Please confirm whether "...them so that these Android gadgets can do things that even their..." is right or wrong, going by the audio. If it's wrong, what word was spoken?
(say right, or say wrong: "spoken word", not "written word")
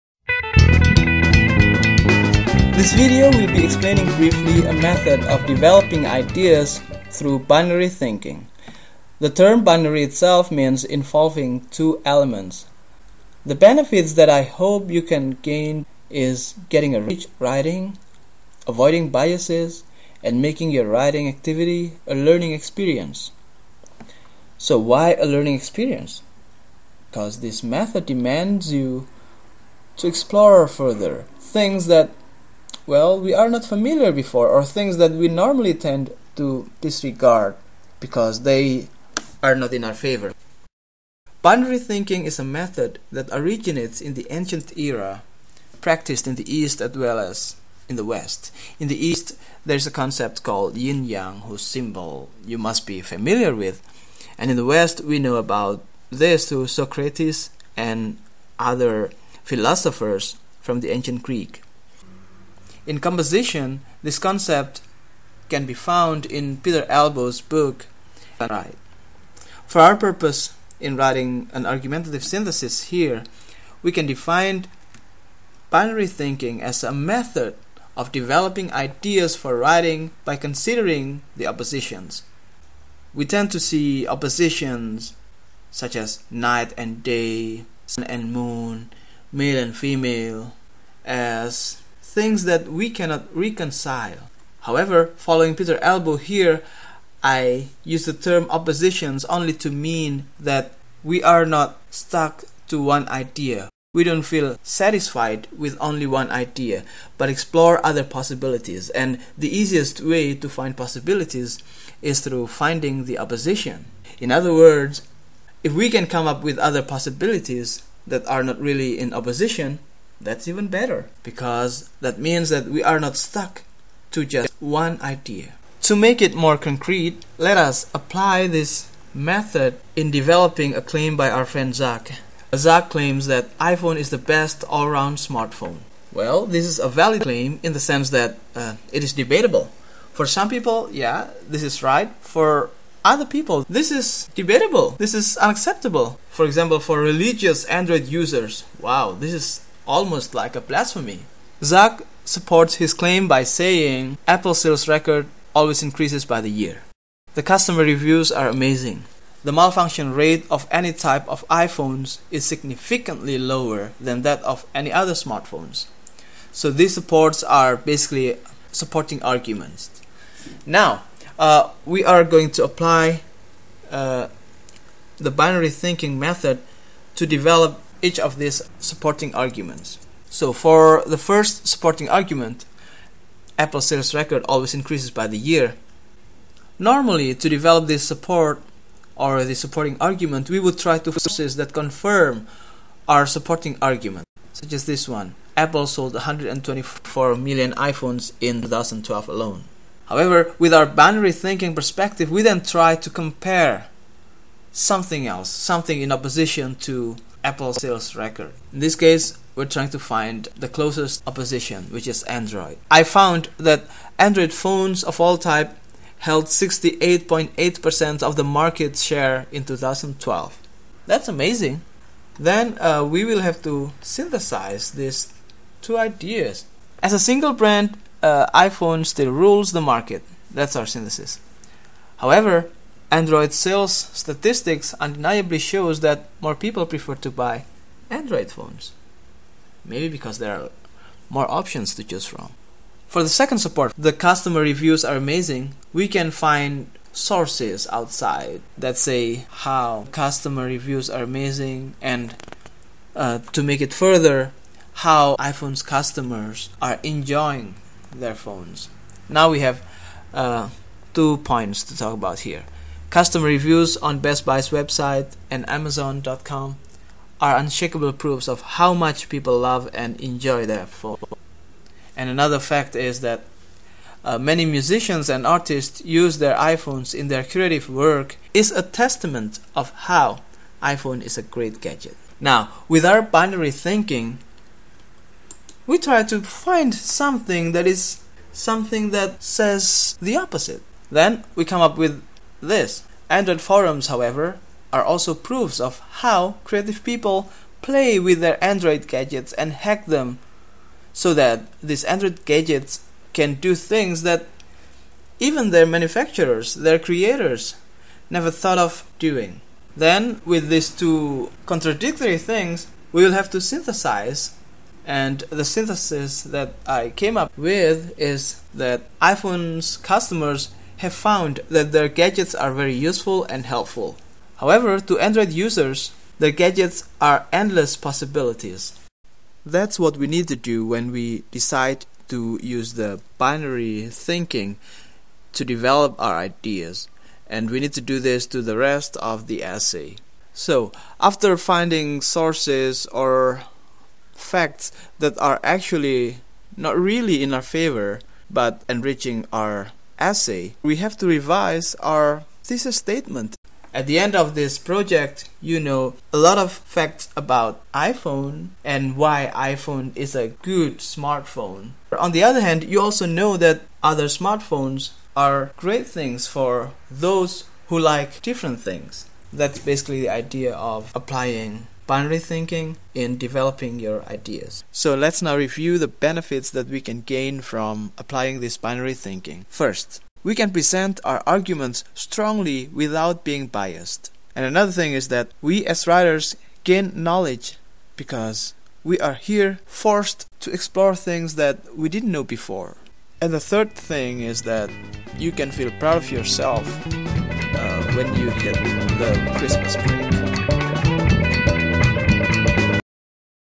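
right.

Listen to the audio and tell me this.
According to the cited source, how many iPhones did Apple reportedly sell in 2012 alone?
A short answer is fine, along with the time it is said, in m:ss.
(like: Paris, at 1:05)
124 million, at 3:16.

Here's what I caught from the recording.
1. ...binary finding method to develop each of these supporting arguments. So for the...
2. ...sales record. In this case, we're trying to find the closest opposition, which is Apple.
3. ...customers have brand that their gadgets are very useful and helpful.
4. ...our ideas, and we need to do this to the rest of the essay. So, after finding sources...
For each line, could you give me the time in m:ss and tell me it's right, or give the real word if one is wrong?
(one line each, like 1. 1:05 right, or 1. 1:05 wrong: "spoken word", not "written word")
1. 2:55 wrong: "thinking", not "finding"
2. 3:27 wrong: "Android", not "Apple"
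3. 5:19 wrong: "found", not "brand"
4. 5:36 right.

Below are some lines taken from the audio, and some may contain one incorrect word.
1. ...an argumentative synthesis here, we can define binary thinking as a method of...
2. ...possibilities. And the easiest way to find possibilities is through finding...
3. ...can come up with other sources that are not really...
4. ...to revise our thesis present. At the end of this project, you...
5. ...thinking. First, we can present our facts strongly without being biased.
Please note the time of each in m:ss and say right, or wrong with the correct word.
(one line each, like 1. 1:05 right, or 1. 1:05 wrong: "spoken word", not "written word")
1. 1:11 right
2. 1:48 right
3. 1:55 wrong: "possibilities", not "sources"
4. 5:51 wrong: "statement", not "present"
5. 6:19 wrong: "arguments", not "facts".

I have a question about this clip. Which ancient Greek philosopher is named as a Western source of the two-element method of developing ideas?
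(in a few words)
Socrates.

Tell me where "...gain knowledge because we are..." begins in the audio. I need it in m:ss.
6:26.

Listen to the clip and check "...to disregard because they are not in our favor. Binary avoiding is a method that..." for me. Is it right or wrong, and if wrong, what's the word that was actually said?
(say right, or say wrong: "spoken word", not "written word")
wrong: "thinking", not "avoiding".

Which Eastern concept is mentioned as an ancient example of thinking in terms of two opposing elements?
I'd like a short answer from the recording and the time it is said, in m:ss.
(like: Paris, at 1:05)
yin yang, at 0:50.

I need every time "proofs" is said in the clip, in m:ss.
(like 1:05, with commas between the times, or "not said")
4:28, 4:55.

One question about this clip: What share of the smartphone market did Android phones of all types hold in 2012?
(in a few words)
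68.8%.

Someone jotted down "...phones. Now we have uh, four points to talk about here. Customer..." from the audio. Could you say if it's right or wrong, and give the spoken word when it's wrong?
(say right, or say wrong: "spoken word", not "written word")
wrong: "two", not "four".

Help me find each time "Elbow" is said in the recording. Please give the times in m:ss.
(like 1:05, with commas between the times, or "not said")
1:06, 1:35.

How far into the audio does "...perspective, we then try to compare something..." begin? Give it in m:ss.
3:21.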